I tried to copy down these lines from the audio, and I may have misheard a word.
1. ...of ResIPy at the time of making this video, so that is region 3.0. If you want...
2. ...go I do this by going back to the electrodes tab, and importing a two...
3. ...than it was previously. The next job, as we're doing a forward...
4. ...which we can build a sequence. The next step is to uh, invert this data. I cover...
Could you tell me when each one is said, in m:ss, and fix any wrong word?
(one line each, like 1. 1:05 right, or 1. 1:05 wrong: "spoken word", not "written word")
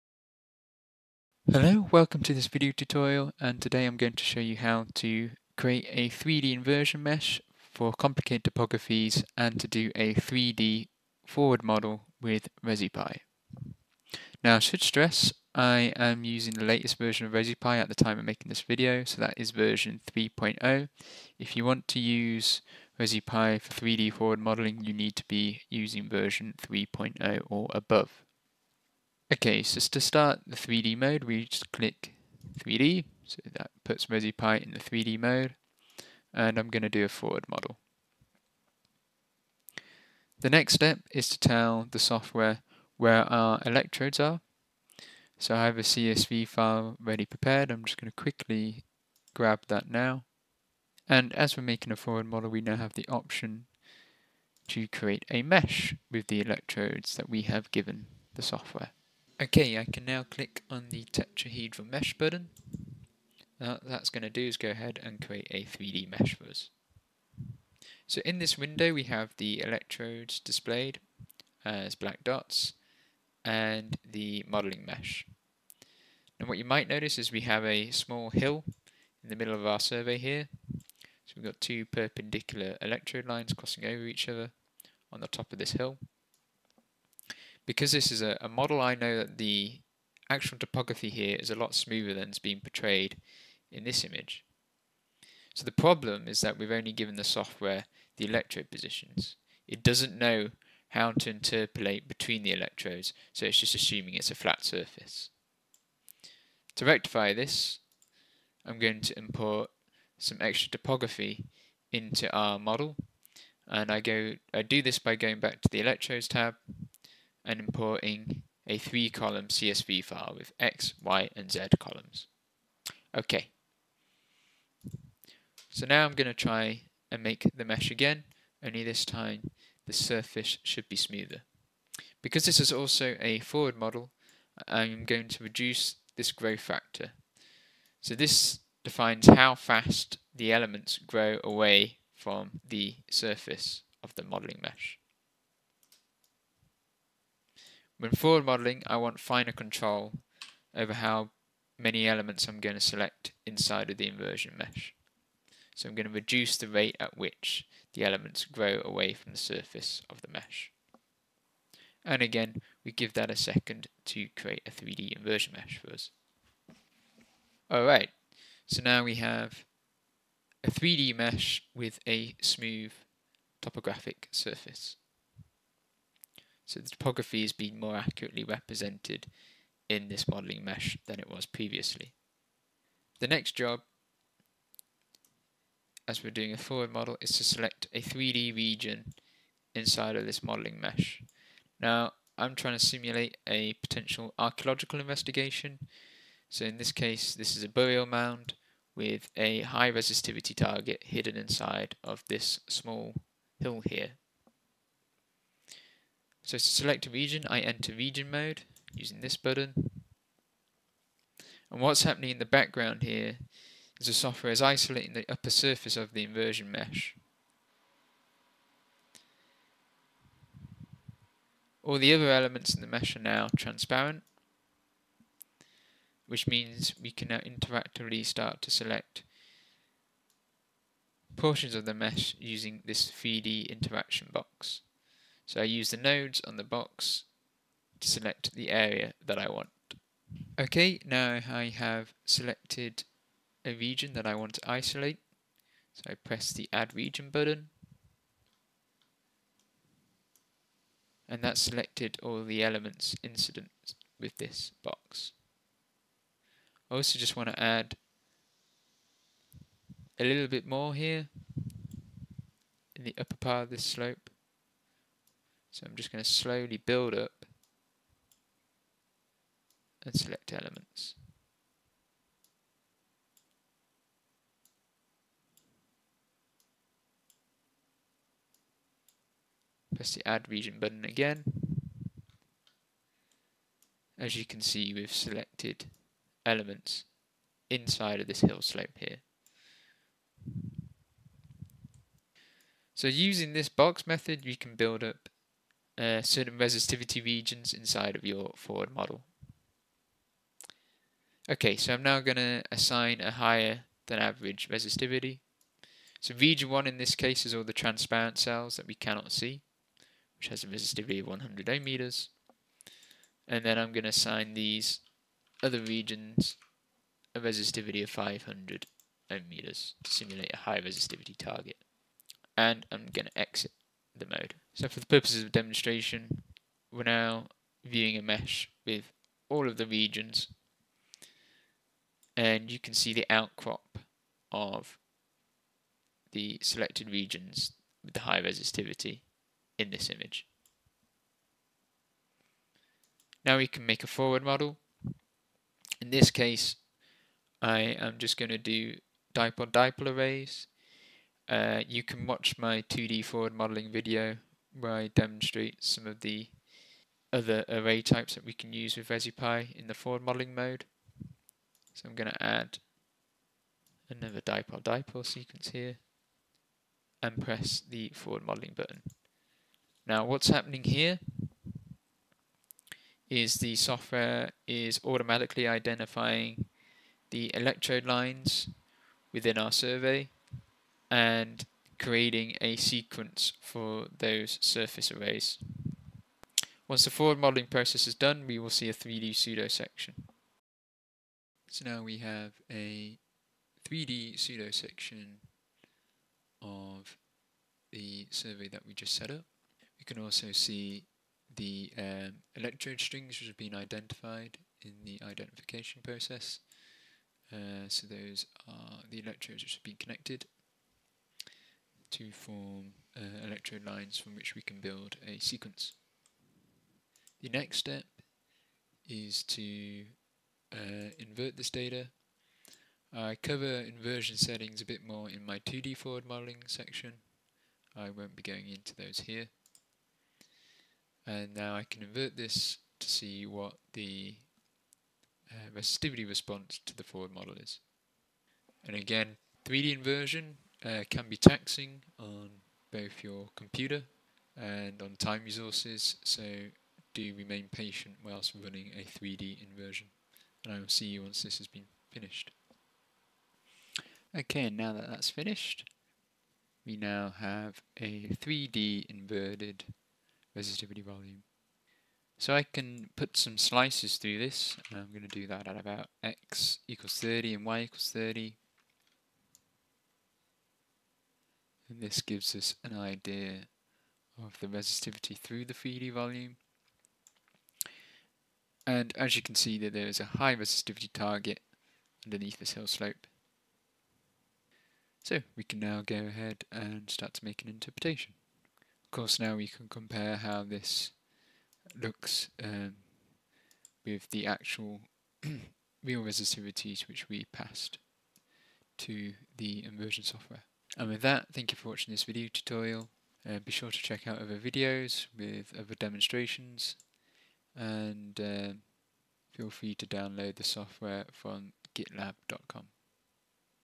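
1. 0:17 wrong: "version", not "region"
2. 1:54 wrong: "three", not "two"
3. 3:01 right
4. 6:54 right.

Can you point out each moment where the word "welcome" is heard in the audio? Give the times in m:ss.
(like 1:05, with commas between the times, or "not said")
0:01.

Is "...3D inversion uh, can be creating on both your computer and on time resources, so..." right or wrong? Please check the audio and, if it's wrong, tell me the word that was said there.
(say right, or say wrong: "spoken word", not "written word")
wrong: "taxing", not "creating".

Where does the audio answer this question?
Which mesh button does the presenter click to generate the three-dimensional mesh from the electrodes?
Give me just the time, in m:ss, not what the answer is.
1:01.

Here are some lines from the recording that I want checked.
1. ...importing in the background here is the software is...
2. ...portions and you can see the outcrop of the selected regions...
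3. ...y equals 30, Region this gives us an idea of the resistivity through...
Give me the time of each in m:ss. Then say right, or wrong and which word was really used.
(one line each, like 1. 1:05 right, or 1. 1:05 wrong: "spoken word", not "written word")
1. 3:32 wrong: "happening", not "importing"
2. 5:29 wrong: "regions", not "portions"
3. 7:47 wrong: "And", not "Region".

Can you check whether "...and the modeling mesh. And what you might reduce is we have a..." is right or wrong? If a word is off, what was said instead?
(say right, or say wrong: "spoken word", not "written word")
wrong: "notice", not "reduce".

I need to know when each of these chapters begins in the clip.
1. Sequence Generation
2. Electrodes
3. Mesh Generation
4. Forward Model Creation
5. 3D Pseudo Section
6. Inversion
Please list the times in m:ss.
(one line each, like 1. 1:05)
1. 5:42
2. 0:40
3. 0:55
4. 3:15
5. 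6:30
6. 6:56.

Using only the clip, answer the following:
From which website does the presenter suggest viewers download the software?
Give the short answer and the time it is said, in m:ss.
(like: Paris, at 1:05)
gitlab.com, at 8:31.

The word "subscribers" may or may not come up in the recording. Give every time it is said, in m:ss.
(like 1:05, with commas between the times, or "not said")
not said.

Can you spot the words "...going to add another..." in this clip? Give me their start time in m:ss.
6:02.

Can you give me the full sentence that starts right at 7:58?
And as you can see that there is a high resistivity target underneath this hill slope.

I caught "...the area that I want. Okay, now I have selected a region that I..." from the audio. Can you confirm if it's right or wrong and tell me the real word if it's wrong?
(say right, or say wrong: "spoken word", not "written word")
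right.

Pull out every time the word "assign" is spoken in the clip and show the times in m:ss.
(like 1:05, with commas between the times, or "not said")
5:02, 5:14.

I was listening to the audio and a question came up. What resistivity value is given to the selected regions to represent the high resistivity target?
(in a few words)
500 ohm meters.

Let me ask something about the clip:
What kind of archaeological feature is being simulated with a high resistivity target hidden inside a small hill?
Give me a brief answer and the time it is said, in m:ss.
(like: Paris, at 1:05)
Burial mound, at 3:17.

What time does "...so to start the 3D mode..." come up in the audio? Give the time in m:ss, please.
0:29.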